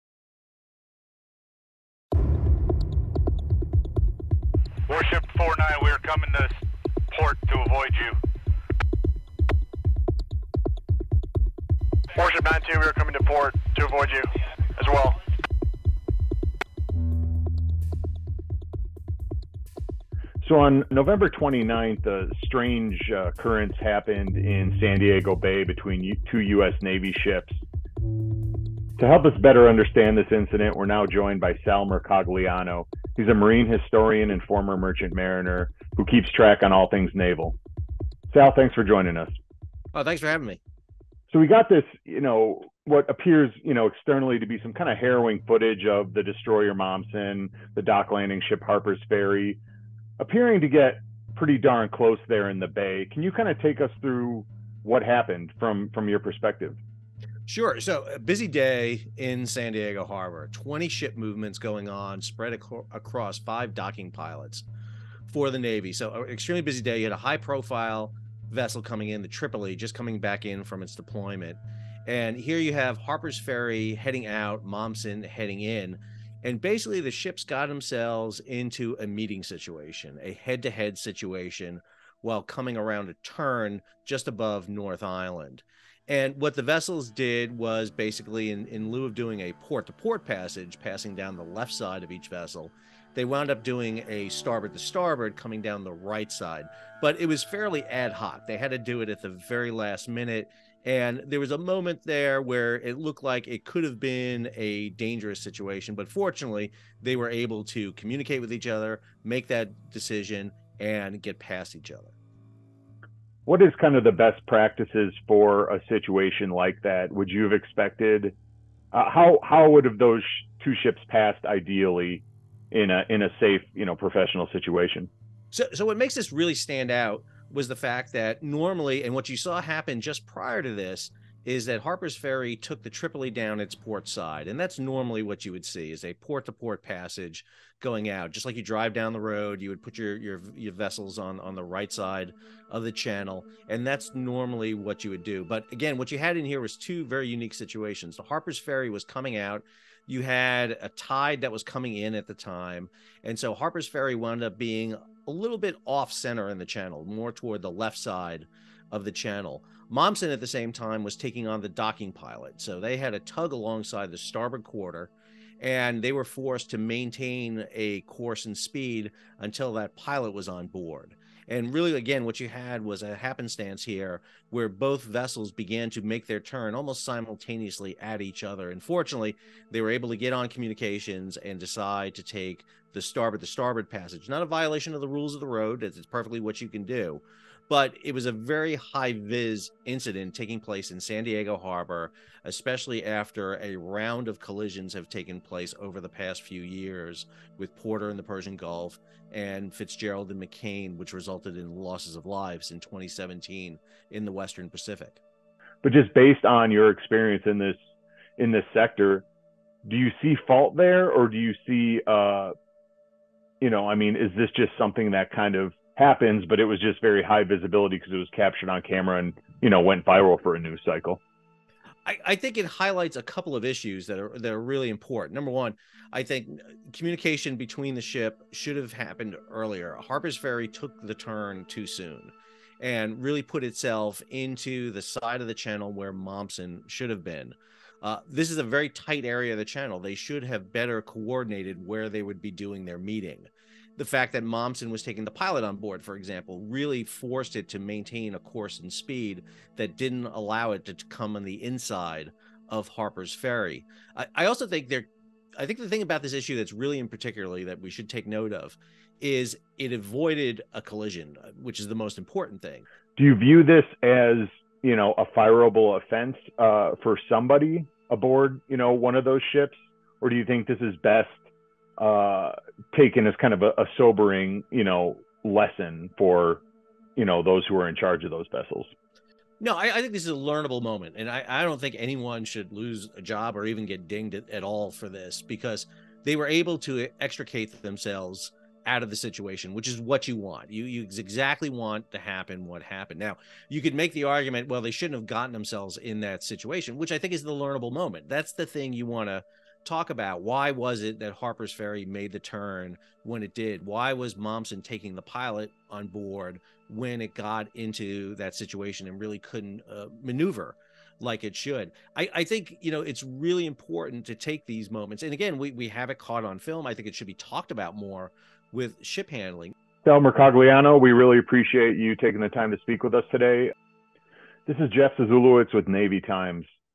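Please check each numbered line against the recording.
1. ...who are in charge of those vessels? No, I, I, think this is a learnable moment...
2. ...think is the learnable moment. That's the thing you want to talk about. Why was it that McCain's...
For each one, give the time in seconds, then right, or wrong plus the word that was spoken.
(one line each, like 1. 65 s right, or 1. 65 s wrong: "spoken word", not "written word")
1. 277 s right
2. 297 s wrong: "Harper", not "McCain".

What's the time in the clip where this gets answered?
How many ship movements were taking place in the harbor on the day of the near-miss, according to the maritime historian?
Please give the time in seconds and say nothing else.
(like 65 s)
60 s.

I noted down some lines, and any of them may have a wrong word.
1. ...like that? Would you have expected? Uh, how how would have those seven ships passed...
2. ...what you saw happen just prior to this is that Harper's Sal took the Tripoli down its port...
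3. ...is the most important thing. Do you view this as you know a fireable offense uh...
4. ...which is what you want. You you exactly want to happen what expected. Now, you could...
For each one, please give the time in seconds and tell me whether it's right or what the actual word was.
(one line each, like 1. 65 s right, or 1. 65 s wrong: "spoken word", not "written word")
1. 116 s wrong: "two", not "seven"
2. 129 s wrong: "Ferry", not "Sal"
3. 261 s right
4. 289 s wrong: "happened", not "expected".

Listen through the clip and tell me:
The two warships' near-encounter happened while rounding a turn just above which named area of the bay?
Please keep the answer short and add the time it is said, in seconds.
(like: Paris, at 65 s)
North Island, at 84 s.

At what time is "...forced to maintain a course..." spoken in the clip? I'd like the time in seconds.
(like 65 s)
166 s.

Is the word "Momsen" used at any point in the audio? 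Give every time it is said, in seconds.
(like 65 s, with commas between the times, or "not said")
46 s, 74 s, 159 s, 236 s, 244 s, 304 s.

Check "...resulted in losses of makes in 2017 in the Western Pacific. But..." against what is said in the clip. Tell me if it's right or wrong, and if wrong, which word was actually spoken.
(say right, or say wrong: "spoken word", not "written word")
wrong: "lives", not "makes".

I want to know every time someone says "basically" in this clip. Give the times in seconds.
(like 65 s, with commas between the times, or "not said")
76 s, 87 s.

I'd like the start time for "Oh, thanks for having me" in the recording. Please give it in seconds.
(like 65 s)
39 s.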